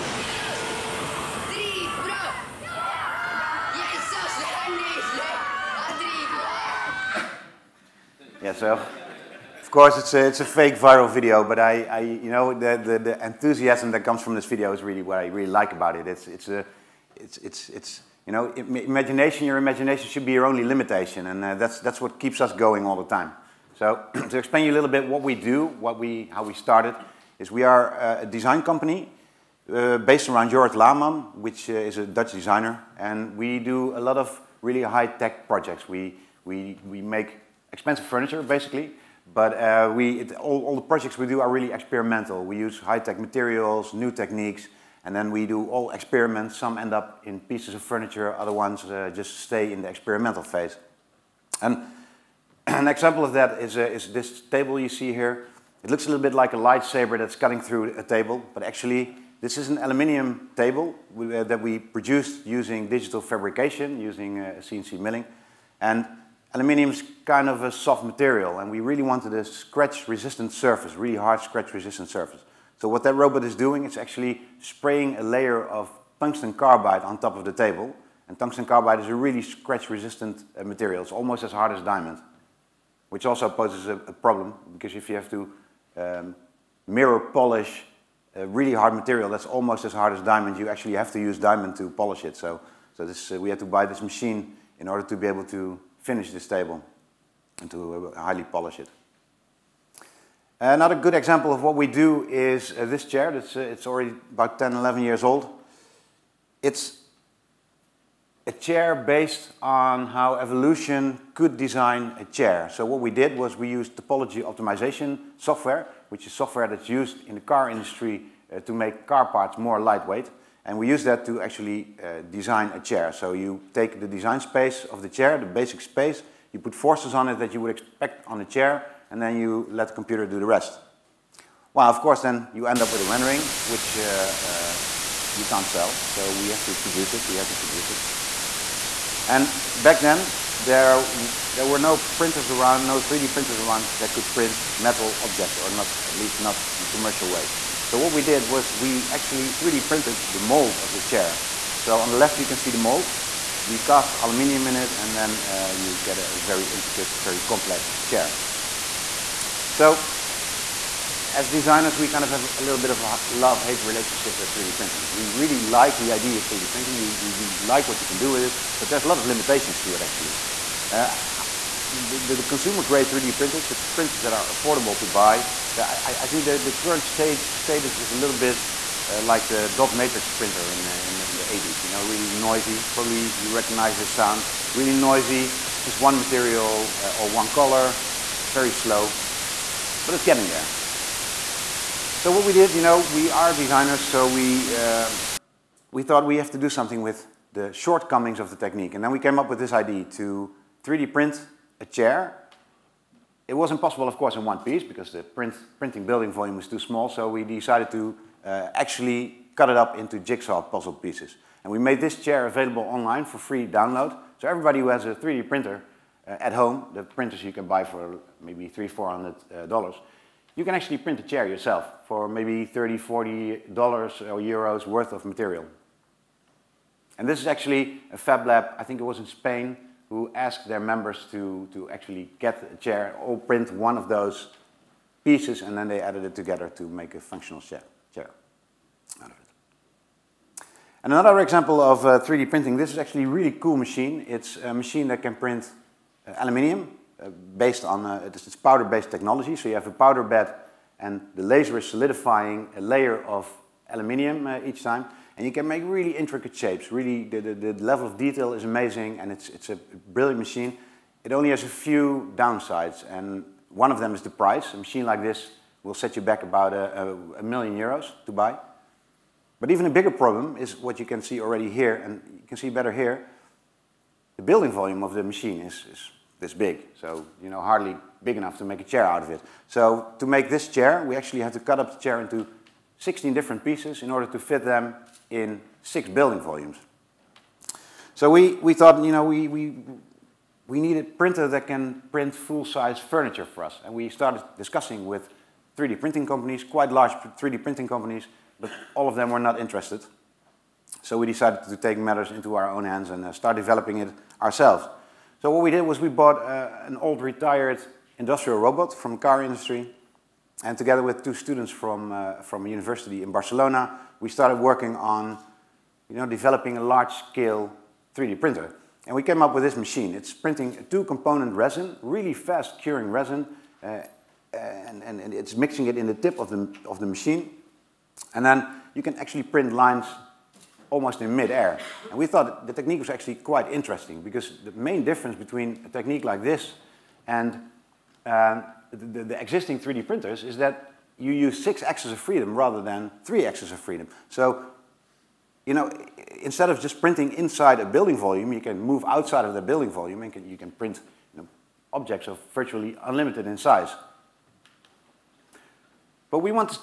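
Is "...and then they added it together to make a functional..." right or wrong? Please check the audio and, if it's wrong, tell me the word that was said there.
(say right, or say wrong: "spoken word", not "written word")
right.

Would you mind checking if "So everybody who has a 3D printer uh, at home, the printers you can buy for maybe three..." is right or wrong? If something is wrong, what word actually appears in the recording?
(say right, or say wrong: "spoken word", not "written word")
right.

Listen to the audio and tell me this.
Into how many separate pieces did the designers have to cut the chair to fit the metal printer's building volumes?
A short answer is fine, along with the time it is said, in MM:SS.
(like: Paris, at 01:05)
16, at 04:43.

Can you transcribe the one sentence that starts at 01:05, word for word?
And Aluminium is kind of a soft material, and we really wanted a scratch-resistant surface, really hard scratch-resistant surface.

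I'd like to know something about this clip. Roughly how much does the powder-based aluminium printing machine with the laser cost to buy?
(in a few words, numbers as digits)
1 million euros.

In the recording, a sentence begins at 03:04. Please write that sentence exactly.
Really noisy, just one material uh, or one color.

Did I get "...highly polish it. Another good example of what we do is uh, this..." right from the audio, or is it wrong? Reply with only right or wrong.
right.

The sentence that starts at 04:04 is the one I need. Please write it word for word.
It's a machine that can print uh, aluminium uh, based on, uh, it's powder-based technology.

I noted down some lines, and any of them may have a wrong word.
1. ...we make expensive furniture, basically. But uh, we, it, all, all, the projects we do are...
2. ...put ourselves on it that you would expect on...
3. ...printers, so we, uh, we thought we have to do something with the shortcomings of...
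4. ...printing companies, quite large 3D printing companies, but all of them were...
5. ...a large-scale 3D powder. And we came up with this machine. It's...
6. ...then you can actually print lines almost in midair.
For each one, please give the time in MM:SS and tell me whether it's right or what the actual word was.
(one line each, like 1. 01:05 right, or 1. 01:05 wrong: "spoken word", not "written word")
1. 00:36 right
2. 02:06 wrong: "forces", not "ourselves"
3. 03:13 wrong: "designers", not "printers"
4. 04:55 right
5. 05:16 wrong: "printer", not "powder"
6. 05:28 right.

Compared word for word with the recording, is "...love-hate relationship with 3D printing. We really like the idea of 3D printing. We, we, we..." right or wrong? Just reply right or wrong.
right.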